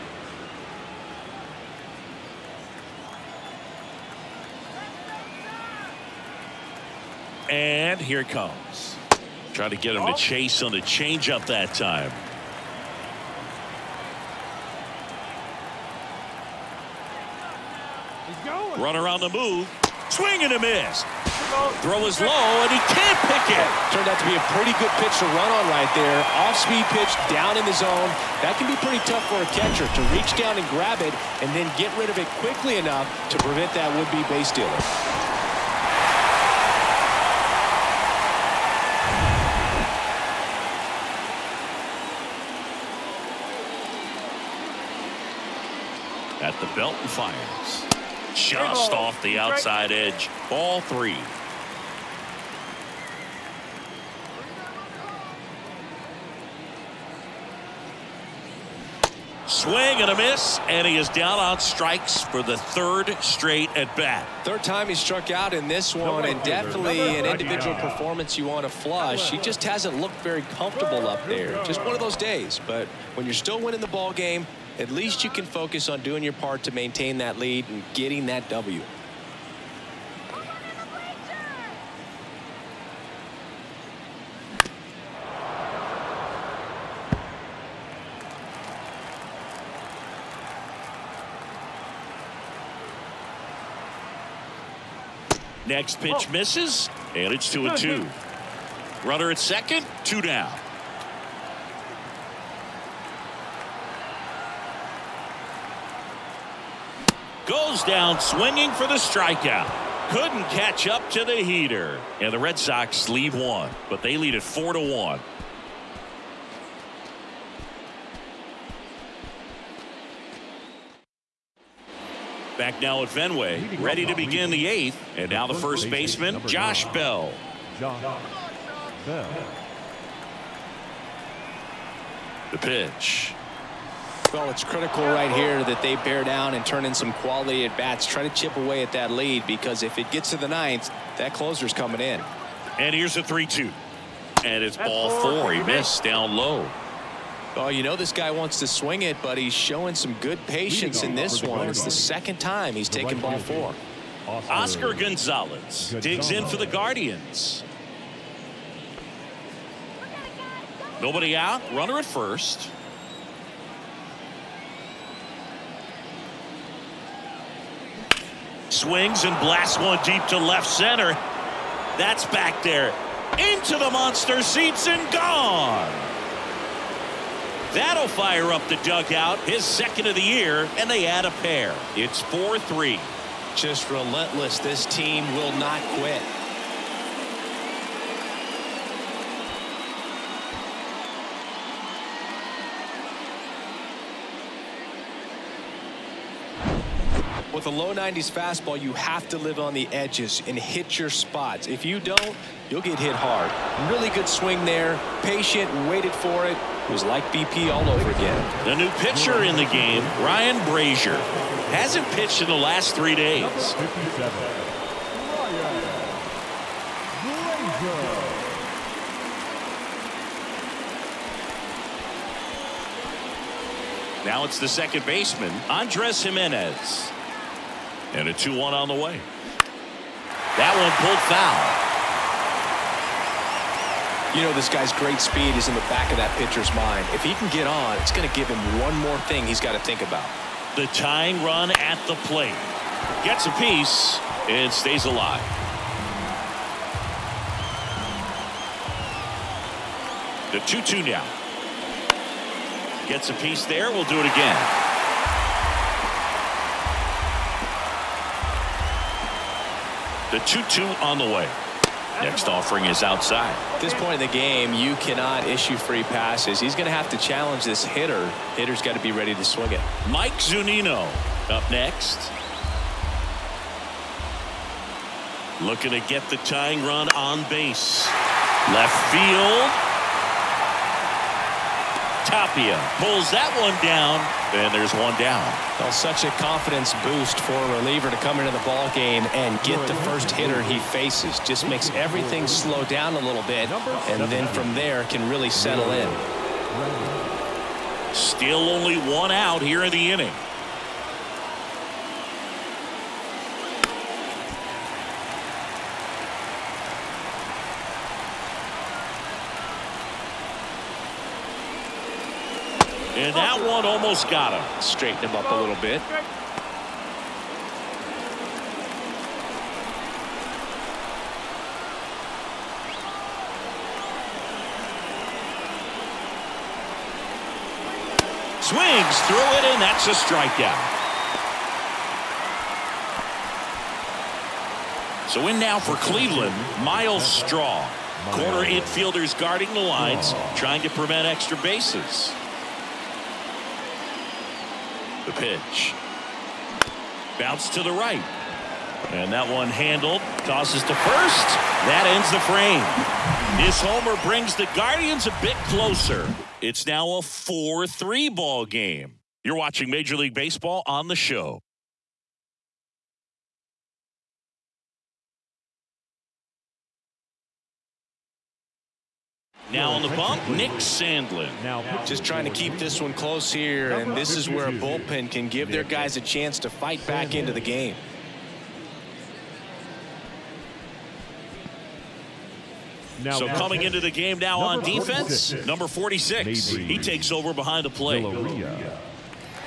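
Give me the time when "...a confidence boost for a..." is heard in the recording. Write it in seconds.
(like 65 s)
286 s.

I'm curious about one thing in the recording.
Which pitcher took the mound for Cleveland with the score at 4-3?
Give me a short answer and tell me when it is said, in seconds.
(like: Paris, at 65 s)
Nick Sandlin, at 370 s.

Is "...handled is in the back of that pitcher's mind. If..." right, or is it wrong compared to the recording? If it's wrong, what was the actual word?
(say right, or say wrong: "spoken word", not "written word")
wrong: "speed", not "handled".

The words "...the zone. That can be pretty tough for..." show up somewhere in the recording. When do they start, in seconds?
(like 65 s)
27 s.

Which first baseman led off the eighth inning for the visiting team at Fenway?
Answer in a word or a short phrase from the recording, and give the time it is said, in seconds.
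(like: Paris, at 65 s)
Josh Bell, at 126 s.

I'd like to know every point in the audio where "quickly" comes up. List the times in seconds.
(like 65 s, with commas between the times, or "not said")
32 s.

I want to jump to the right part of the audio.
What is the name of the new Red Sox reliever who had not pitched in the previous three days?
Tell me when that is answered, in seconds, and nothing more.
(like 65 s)
210 s.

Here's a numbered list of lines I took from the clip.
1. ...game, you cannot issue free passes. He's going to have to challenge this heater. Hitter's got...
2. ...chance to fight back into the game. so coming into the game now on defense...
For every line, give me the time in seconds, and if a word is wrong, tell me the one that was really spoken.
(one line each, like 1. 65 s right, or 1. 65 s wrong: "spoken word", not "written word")
1. 264 s wrong: "hitter", not "heater"
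2. 376 s right.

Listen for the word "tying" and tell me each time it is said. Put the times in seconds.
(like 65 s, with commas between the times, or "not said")
240 s, 276 s.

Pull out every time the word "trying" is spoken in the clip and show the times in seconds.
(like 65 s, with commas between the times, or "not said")
340 s, 372 s.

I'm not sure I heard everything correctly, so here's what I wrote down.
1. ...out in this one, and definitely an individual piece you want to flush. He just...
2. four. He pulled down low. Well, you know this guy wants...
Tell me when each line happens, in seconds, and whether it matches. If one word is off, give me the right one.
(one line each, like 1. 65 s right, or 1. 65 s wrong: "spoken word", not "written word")
1. 65 s wrong: "performance", not "piece"
2. 145 s wrong: "missed", not "pulled".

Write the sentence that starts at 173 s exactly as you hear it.
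Into the monster seats and gone.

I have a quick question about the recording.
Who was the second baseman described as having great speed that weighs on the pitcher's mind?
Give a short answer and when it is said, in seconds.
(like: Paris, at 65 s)
Andres Gimenez, at 225 s.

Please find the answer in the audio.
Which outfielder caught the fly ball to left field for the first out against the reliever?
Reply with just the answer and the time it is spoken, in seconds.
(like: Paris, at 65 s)
Tapia, at 282 s.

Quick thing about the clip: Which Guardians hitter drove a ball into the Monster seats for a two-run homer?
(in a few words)
Oscar Gonzalez.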